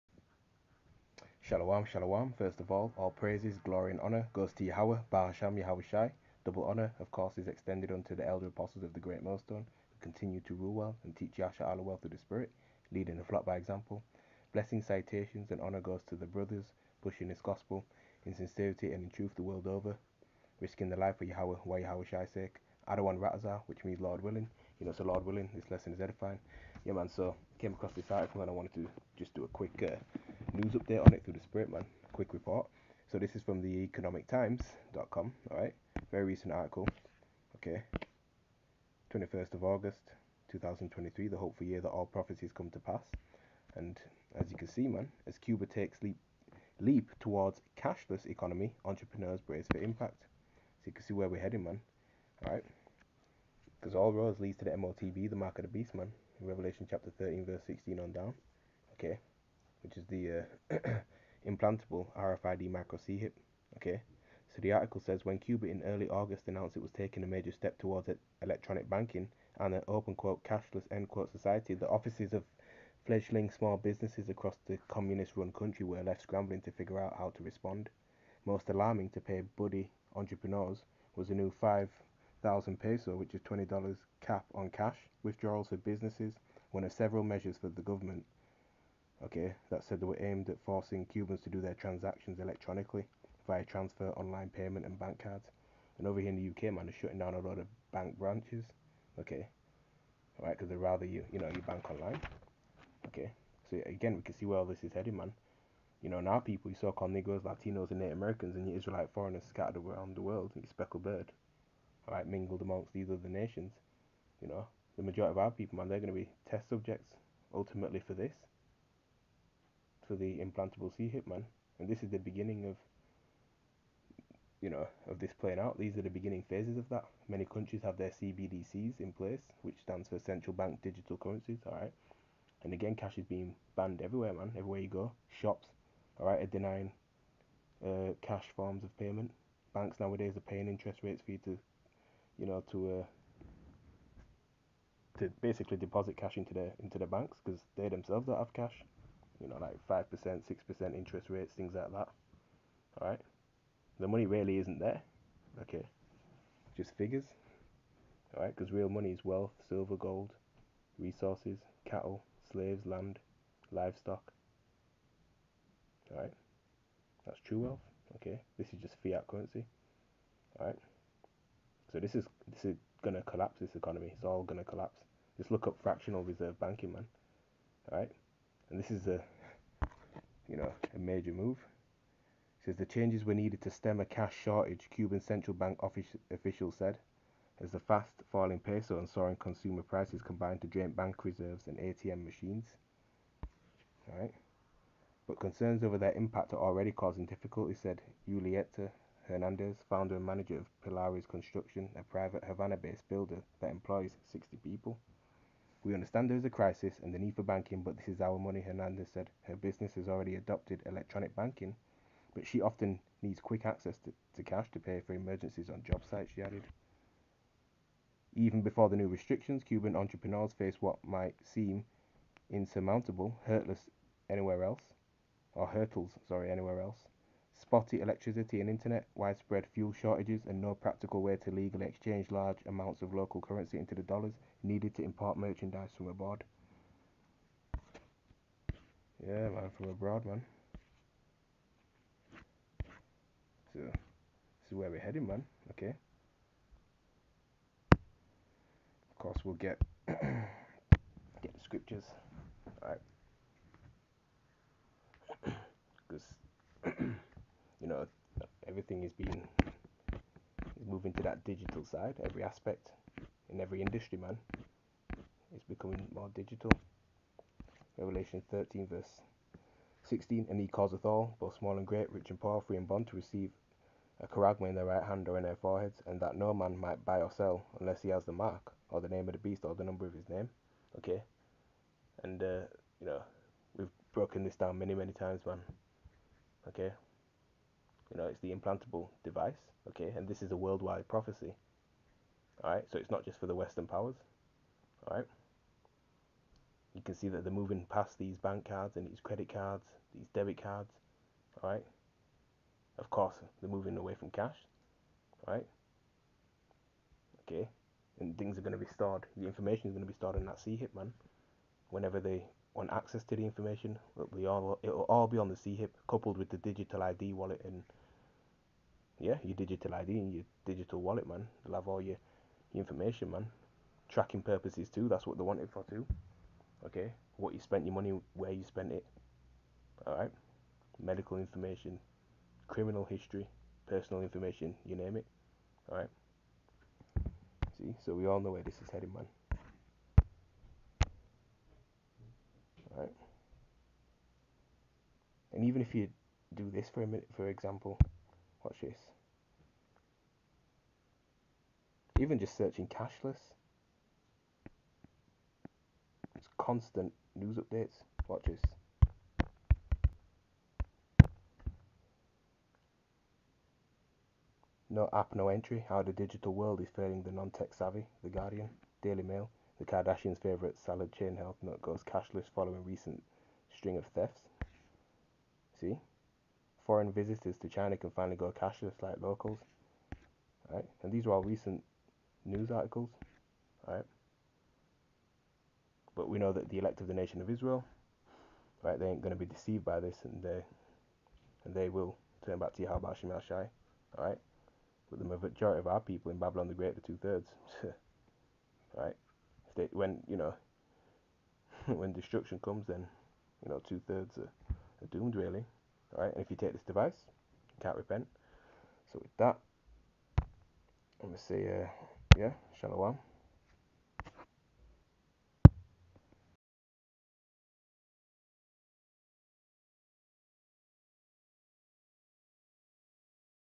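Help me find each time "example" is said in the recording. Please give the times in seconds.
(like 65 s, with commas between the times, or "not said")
13 s, 347 s.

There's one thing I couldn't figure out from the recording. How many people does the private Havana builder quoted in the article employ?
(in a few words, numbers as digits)
60.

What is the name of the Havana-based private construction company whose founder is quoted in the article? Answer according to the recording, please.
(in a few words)
Pilares Construction.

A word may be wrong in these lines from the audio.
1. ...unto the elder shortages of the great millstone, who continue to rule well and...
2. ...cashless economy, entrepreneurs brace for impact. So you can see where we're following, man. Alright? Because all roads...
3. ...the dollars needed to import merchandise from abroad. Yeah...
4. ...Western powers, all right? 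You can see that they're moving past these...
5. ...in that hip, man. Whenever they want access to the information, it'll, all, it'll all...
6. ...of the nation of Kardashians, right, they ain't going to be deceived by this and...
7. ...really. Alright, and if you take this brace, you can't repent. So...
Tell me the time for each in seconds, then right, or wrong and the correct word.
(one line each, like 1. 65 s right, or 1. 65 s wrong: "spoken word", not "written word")
1. 7 s wrong: "apostles", not "shortages"
2. 47 s wrong: "heading", not "following"
3. 233 s right
4. 293 s right
5. 310 s right
6. 387 s wrong: "Israel", not "Kardashians"
7. 405 s wrong: "device", not "brace".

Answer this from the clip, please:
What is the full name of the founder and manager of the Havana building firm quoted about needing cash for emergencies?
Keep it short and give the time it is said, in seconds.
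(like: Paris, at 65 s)
Julieta Hernandez, at 198 s.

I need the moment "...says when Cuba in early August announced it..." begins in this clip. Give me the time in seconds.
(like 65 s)
65 s.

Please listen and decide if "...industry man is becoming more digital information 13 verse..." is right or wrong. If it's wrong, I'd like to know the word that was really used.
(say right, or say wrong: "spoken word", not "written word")
wrong: "revelation", not "information".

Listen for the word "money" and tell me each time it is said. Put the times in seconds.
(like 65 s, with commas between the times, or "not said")
154 s, 158 s, 208 s, 327 s.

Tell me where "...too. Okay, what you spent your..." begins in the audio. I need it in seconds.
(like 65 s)
325 s.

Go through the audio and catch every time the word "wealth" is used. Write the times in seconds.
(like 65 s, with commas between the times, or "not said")
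159 s, 167 s.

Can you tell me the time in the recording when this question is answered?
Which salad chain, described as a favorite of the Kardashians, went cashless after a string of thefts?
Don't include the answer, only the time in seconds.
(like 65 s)
371 s.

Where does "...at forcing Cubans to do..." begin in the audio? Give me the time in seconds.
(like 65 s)
90 s.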